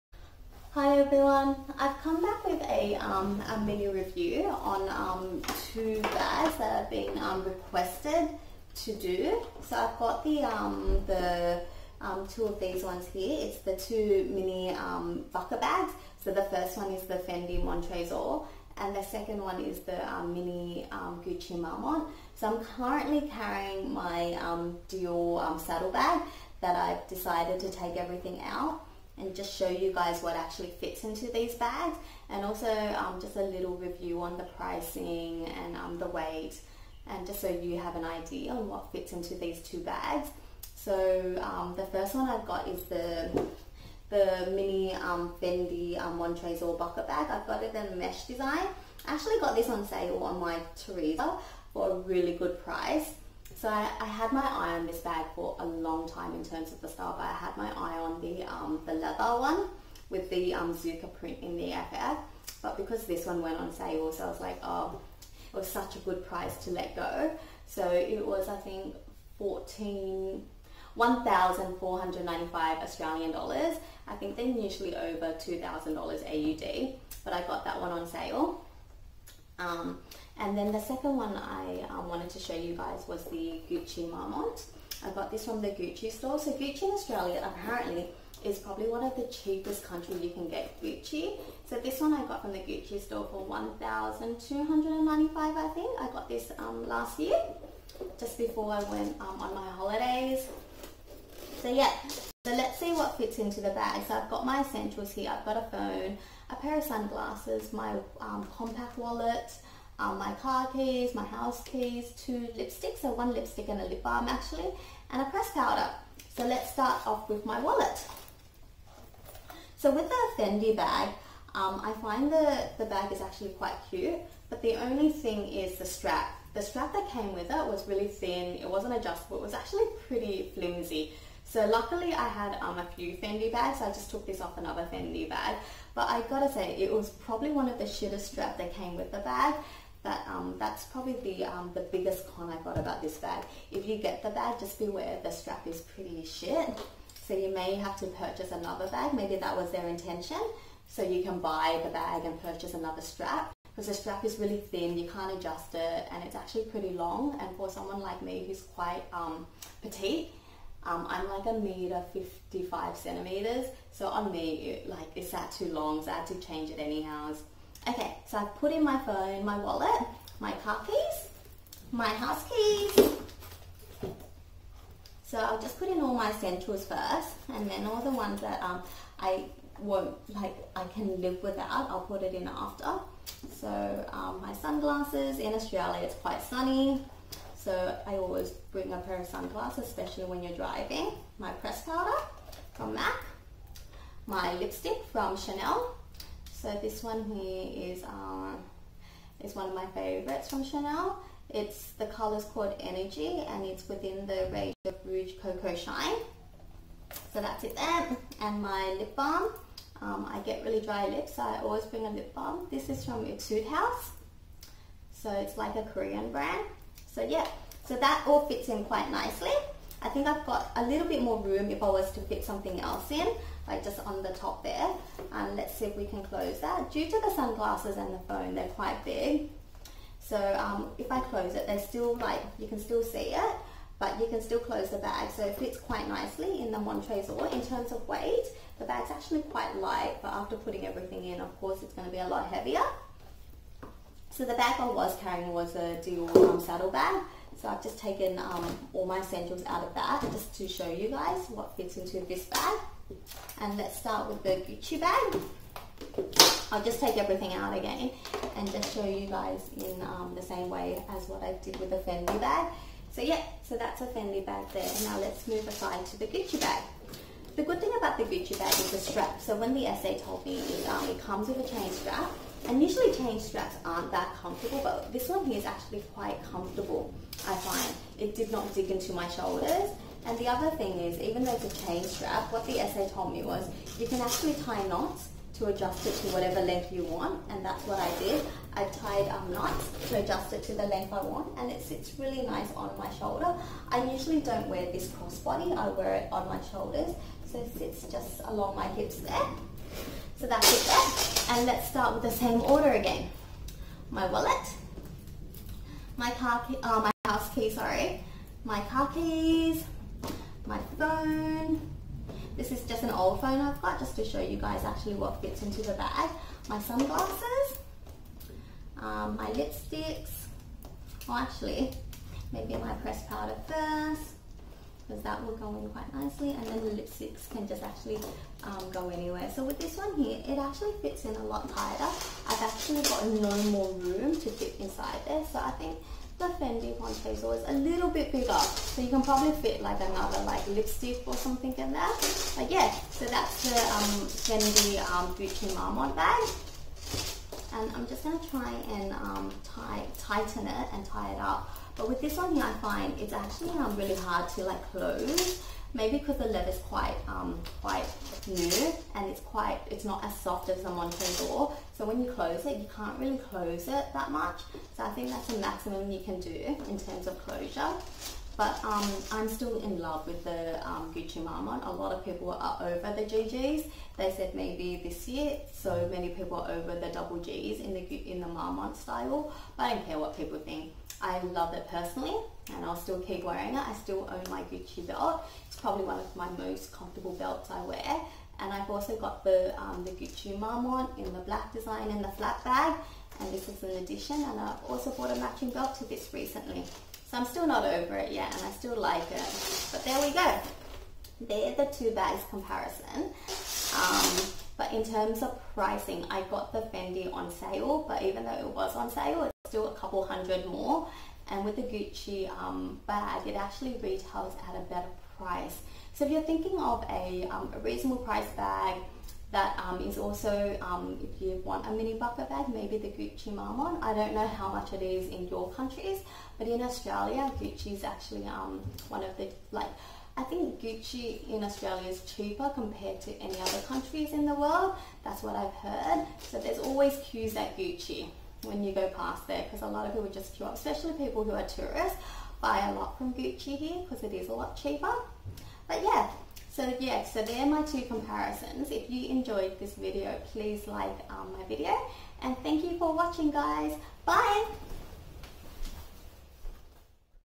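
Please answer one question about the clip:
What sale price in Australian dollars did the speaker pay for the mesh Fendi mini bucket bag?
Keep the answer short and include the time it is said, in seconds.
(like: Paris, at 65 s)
1,495, at 70 s.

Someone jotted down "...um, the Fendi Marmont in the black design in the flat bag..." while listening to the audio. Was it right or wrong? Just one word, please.
wrong.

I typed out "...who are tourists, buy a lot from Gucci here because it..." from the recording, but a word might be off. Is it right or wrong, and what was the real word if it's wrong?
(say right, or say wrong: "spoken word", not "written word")
right.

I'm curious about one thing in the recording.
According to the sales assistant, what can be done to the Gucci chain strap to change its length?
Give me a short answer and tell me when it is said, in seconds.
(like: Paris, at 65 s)
Tie knots, at 284 s.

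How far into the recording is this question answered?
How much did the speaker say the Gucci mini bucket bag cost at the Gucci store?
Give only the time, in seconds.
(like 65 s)
93 s.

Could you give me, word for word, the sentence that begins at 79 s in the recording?
Um, and then the second one I um, wanted to show you guys was the Gucci Marmont.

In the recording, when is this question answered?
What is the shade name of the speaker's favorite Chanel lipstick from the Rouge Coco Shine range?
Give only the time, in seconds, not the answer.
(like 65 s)
202 s.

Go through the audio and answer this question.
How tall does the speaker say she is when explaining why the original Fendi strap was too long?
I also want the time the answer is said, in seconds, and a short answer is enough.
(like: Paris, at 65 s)
1 meter 55 centimeters, at 161 s.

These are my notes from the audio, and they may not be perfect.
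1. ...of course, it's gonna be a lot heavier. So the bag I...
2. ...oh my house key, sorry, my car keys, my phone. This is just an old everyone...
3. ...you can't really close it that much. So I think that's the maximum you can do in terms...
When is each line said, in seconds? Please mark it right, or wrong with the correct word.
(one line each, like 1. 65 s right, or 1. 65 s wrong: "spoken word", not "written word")
1. 241 s right
2. 306 s wrong: "phone", not "everyone"
3. 362 s right.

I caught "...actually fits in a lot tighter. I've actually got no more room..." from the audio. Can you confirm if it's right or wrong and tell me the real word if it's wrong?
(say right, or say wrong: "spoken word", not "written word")
right.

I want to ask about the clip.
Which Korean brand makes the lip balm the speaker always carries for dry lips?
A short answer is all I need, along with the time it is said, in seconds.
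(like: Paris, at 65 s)
Etude House, at 213 s.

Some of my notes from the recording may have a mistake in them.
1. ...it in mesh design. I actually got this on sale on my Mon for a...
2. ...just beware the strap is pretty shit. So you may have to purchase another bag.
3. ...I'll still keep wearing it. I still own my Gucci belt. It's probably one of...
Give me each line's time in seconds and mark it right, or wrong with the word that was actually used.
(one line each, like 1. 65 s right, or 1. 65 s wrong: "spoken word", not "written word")
1. 47 s wrong: "Teresa", not "Mon"
2. 144 s right
3. 382 s right.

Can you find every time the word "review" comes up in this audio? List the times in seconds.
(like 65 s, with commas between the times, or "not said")
3 s, 33 s.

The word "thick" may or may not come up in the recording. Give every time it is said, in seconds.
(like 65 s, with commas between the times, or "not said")
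not said.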